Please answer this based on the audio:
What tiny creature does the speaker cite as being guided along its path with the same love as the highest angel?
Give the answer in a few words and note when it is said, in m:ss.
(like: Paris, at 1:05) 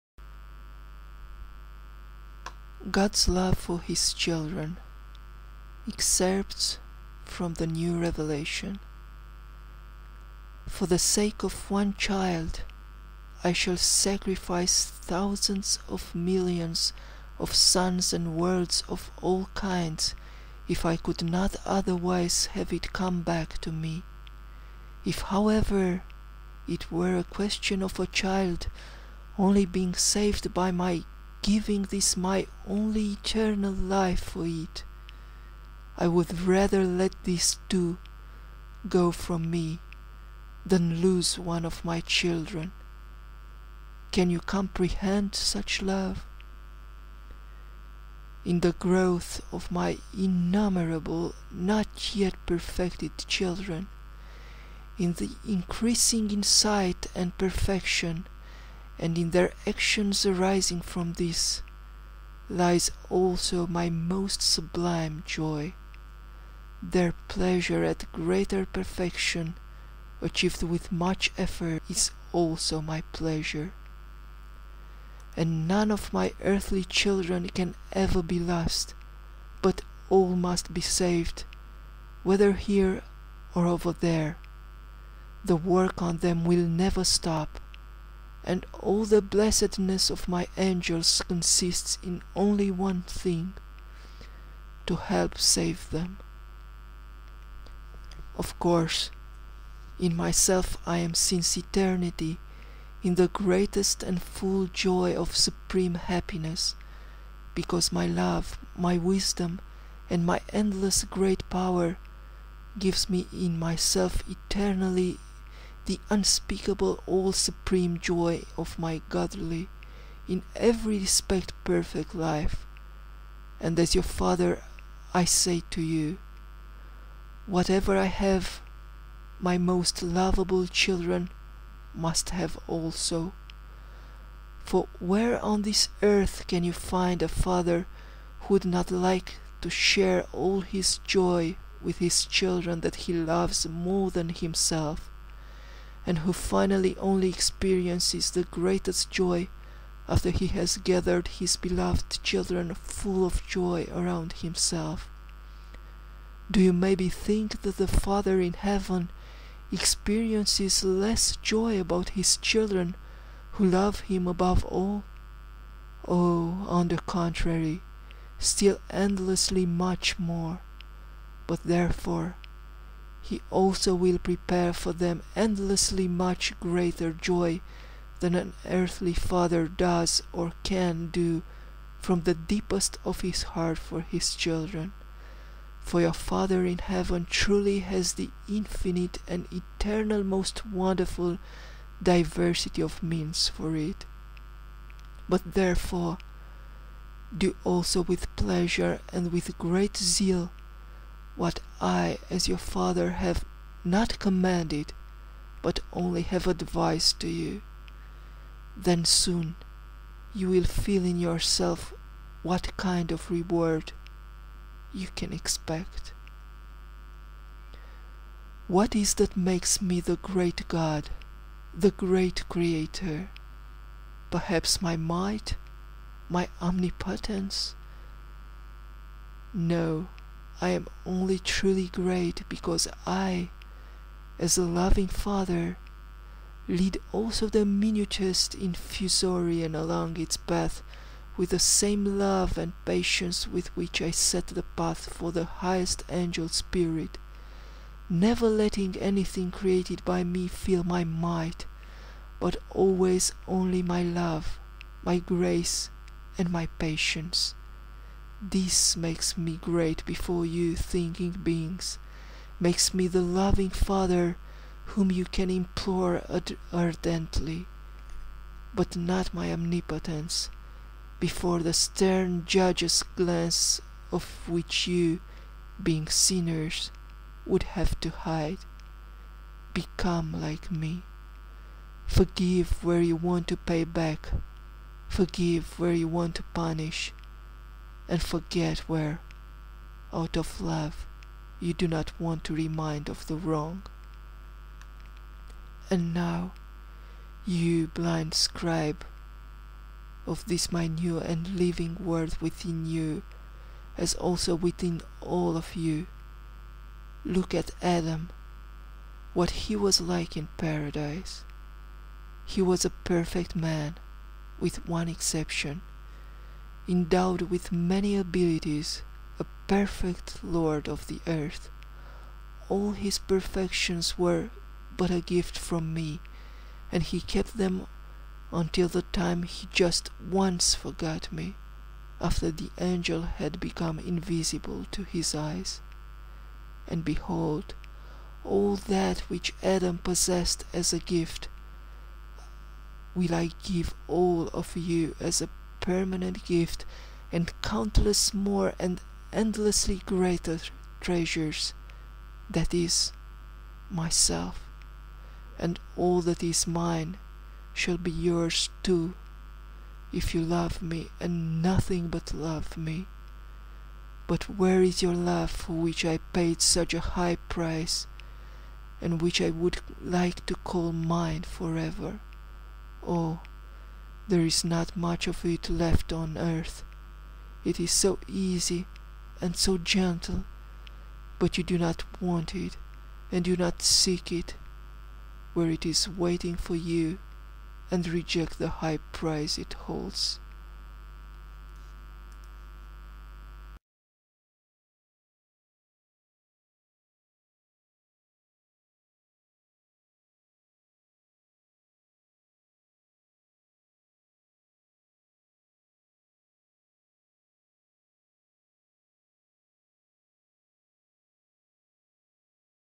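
infusorian, at 3:58.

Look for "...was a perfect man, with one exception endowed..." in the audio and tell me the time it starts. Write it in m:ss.
5:12.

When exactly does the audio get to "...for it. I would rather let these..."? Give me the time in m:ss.
0:34.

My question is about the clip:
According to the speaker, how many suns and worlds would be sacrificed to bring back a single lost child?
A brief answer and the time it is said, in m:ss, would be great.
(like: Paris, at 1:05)
thousands of millions, at 0:14.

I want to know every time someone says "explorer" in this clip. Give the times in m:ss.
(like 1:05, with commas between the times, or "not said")
not said.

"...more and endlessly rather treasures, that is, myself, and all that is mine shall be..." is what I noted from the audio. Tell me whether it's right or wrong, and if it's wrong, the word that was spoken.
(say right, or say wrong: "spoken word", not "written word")
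wrong: "greater", not "rather".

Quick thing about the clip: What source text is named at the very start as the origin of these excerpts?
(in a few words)
the New Revelation.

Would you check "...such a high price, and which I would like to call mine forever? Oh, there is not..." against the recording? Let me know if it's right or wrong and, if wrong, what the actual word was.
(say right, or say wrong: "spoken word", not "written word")
right.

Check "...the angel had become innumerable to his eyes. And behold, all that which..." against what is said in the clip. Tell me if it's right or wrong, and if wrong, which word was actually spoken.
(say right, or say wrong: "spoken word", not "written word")
wrong: "invisible", not "innumerable".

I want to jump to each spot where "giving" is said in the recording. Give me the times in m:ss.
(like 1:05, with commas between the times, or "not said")
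0:31.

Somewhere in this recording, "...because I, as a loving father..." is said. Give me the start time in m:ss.
3:52.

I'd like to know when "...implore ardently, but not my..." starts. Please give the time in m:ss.
4:25.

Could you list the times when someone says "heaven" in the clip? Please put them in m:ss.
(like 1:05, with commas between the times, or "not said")
2:38, 3:06.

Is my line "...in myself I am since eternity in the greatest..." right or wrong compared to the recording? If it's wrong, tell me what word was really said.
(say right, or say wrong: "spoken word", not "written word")
right.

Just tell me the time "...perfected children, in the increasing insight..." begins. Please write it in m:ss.
0:52.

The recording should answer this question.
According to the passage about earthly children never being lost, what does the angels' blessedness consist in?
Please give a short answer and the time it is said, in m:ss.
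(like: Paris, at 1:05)
to help save them, at 1:34.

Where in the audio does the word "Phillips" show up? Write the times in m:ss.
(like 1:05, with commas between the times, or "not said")
not said.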